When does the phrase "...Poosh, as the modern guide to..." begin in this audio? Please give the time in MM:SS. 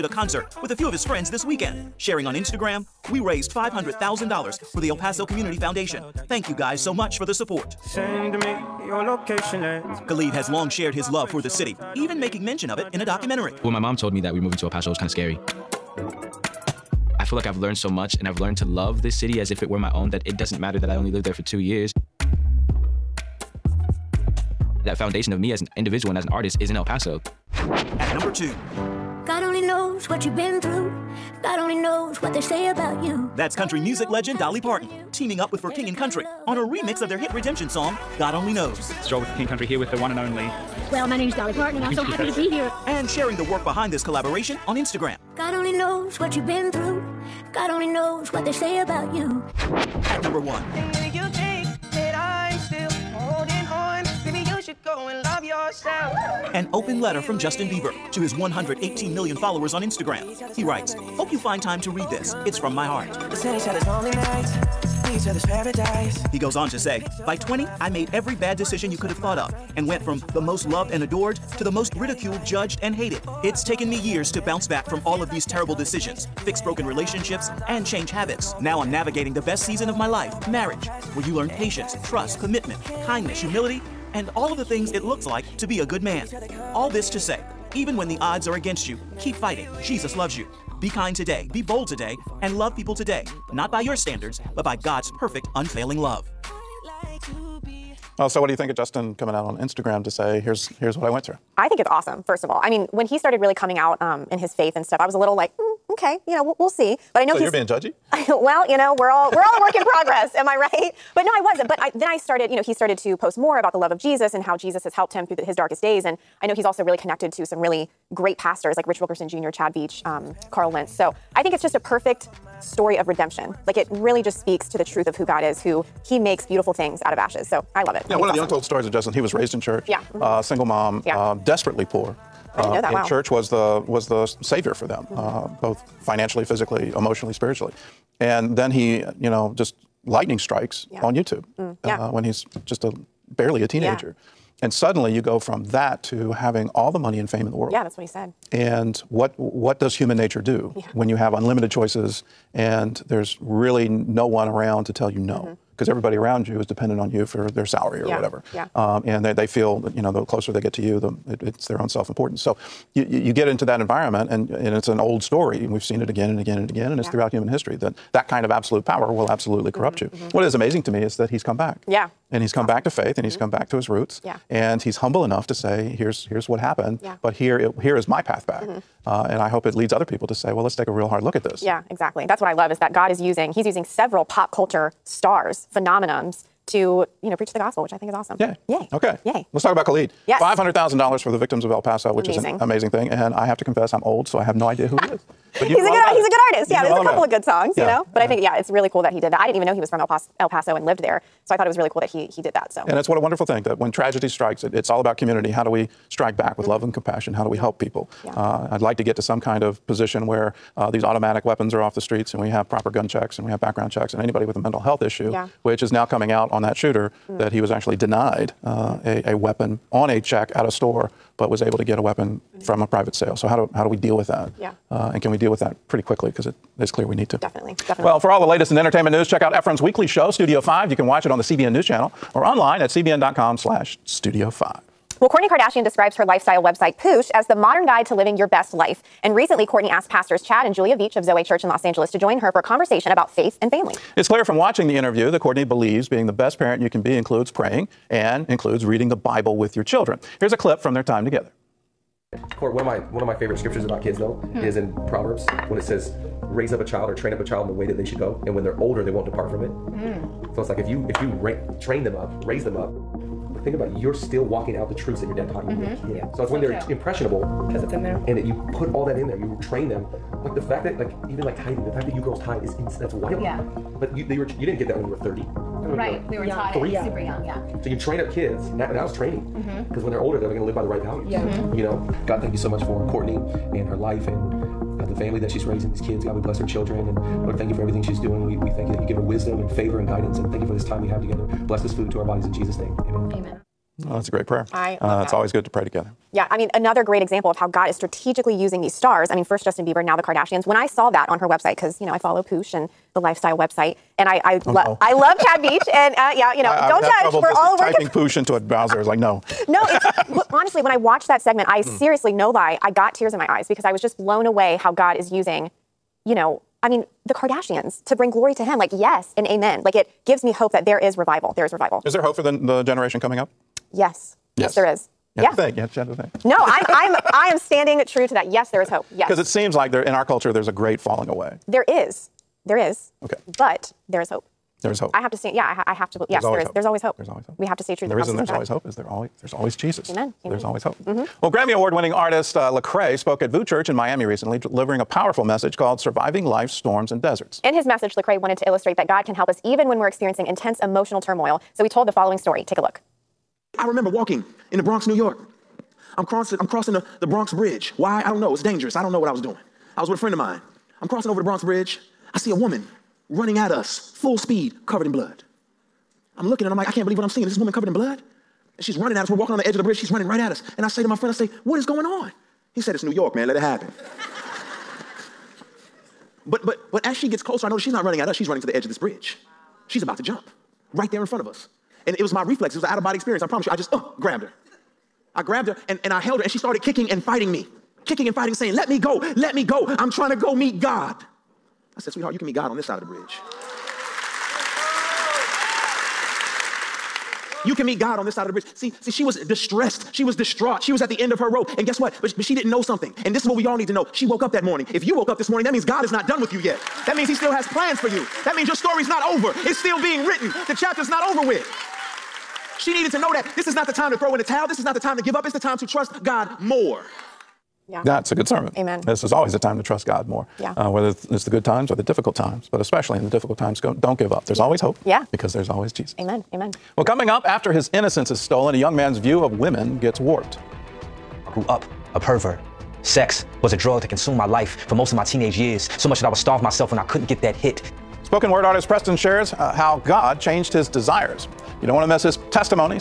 03:56.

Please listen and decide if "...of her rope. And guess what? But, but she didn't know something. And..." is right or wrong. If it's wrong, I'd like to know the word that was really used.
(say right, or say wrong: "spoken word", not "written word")
right.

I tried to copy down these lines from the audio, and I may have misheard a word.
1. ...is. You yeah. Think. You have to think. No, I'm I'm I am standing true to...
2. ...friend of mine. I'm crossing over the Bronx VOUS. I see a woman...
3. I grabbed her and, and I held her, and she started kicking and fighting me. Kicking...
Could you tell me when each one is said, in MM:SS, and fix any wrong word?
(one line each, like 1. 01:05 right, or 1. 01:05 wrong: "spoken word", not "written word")
1. 05:24 right
2. 06:00 wrong: "Bridge", not "VOUS"
3. 06:25 right.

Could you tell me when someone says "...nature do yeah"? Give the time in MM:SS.
02:30.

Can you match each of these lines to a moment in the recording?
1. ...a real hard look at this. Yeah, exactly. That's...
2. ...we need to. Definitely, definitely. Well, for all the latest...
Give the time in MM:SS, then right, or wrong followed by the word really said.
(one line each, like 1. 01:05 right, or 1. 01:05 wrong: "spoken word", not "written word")
1. 03:00 right
2. 03:47 right.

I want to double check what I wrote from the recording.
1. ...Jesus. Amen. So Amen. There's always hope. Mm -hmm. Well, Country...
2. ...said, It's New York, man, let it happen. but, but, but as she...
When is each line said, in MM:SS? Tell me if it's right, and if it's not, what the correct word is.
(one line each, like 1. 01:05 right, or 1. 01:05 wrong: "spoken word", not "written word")
1. 05:39 wrong: "Grammy", not "Country"
2. 06:12 right.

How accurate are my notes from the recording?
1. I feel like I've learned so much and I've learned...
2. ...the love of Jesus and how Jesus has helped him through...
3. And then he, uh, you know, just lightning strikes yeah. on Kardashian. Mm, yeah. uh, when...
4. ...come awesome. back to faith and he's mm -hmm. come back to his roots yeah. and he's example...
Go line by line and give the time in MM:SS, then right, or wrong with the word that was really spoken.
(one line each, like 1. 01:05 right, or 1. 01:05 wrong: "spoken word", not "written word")
1. 00:17 right
2. 01:53 right
3. 02:18 wrong: "YouTube", not "Kardashian"
4. 02:52 wrong: "humble", not "example".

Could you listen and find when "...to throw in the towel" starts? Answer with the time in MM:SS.
06:54.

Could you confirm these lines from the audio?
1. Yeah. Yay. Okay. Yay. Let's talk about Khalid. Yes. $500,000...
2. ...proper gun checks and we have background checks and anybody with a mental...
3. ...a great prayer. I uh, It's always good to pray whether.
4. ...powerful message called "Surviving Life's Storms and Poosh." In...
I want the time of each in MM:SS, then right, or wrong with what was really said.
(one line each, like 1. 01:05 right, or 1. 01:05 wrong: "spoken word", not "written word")
1. 03:08 right
2. 03:32 right
3. 04:54 wrong: "together", not "whether"
4. 05:45 wrong: "Deserts", not "Poosh".